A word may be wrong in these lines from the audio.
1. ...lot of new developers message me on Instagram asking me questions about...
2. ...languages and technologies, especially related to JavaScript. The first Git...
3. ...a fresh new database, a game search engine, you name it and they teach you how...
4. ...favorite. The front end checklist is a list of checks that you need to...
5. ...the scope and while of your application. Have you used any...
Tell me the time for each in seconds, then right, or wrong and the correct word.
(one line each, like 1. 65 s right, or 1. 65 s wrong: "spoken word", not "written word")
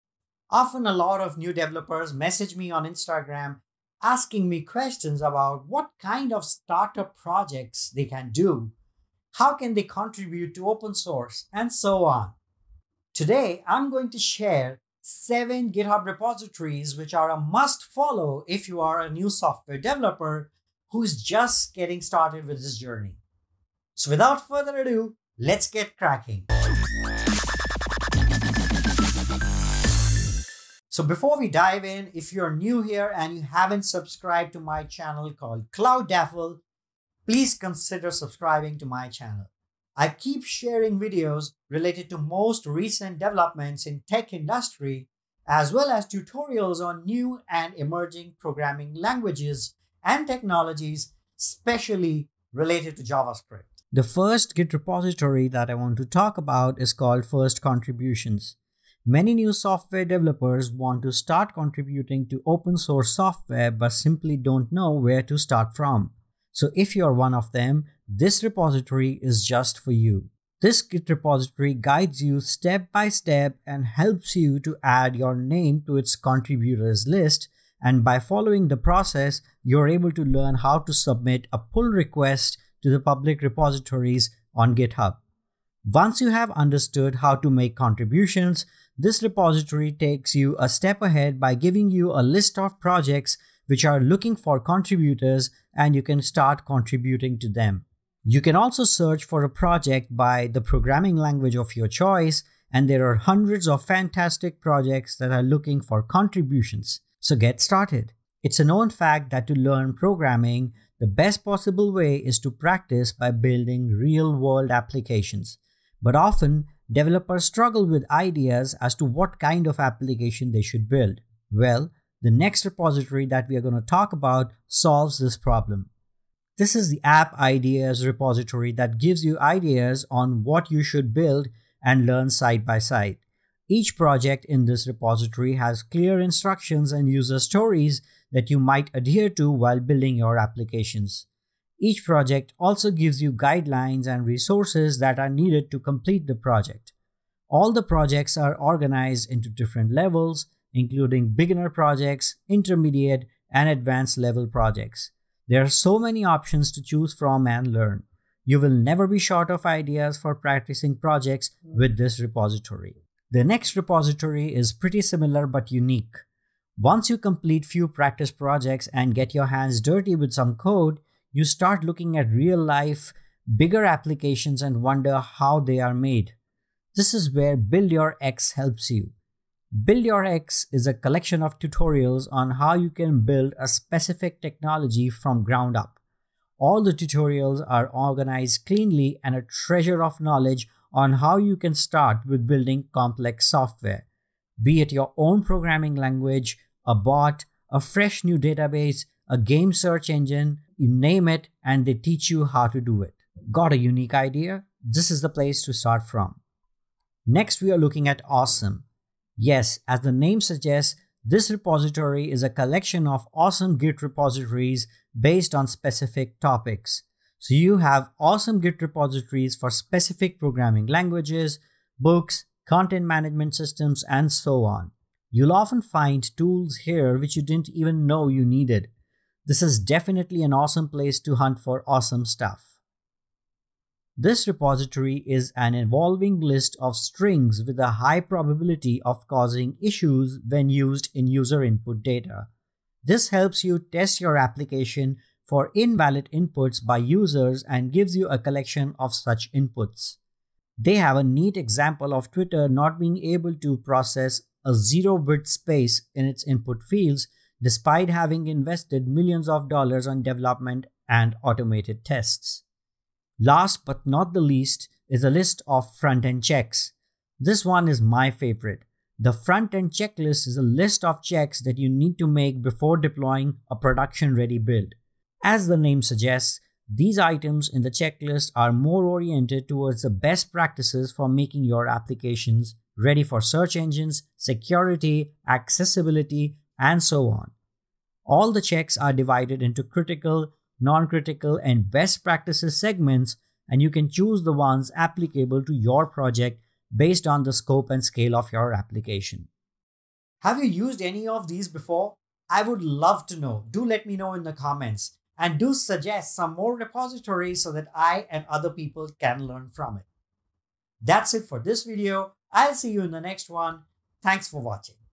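1. 0 s right
2. 48 s right
3. 197 s right
4. 268 s right
5. 297 s wrong: "scale", not "while".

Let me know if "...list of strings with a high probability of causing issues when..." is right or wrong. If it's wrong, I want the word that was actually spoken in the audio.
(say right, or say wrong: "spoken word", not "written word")
right.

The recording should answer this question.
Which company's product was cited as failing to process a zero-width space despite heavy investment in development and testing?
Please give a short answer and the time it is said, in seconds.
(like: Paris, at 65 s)
Twitter, at 252 s.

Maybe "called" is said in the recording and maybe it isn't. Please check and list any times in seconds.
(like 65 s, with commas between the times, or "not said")
35 s, 56 s.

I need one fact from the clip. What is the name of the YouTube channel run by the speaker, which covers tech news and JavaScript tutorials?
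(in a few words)
Cloudaffle.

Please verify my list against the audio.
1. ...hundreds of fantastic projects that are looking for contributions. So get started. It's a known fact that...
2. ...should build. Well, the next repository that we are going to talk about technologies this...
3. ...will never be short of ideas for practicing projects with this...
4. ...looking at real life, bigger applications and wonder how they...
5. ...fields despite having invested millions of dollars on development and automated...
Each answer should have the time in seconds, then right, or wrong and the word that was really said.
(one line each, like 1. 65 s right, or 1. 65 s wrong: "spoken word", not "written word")
1. 103 s right
2. 120 s wrong: "solves", not "technologies"
3. 158 s right
4. 171 s right
5. 256 s right.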